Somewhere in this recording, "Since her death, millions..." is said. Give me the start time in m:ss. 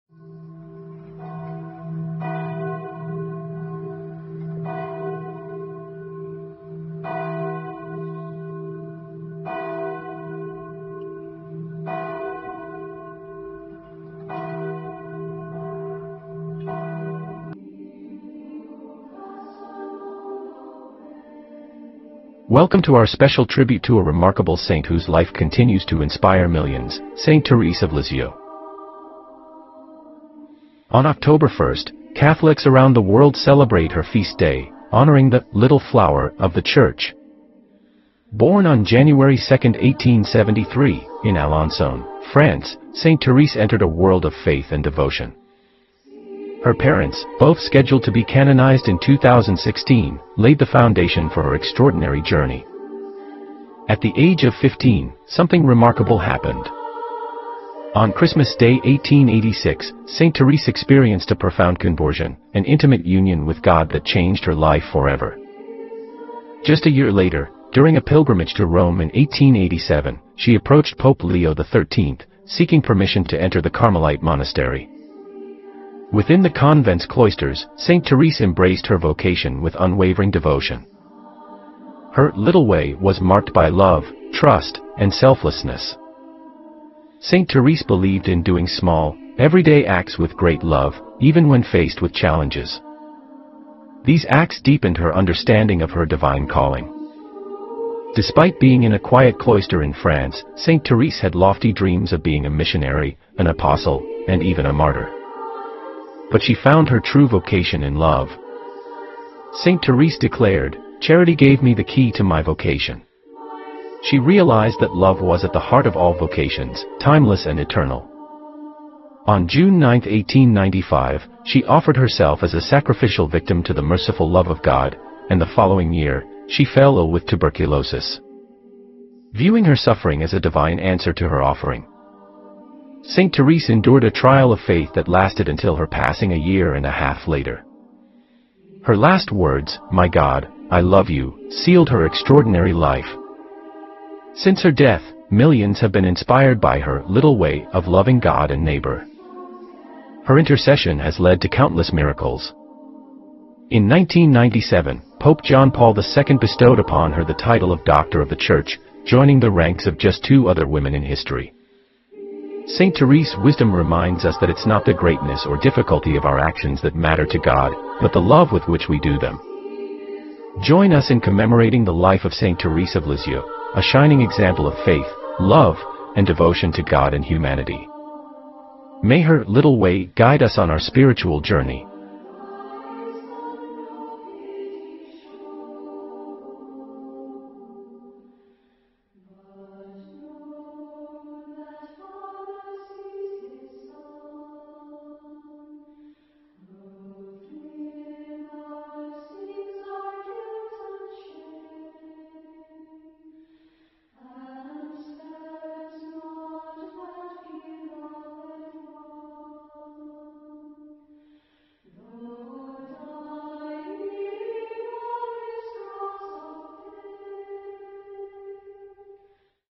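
2:24.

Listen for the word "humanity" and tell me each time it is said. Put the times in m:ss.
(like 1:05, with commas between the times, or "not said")
2:57.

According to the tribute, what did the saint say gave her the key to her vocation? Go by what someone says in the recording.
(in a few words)
Charity.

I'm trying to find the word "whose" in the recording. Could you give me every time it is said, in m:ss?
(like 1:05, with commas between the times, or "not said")
0:24.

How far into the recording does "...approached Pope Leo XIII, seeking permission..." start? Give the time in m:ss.
1:10.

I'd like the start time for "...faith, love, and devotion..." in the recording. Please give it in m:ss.
2:54.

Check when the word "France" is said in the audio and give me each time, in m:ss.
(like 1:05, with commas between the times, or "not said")
0:42, 1:39.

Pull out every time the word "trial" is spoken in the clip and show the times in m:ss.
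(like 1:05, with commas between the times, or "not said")
2:14.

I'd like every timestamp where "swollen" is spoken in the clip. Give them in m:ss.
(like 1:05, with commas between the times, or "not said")
not said.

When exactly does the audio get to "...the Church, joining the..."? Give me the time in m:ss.
2:38.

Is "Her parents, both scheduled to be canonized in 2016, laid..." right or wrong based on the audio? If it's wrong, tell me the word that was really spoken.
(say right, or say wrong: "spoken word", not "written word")
right.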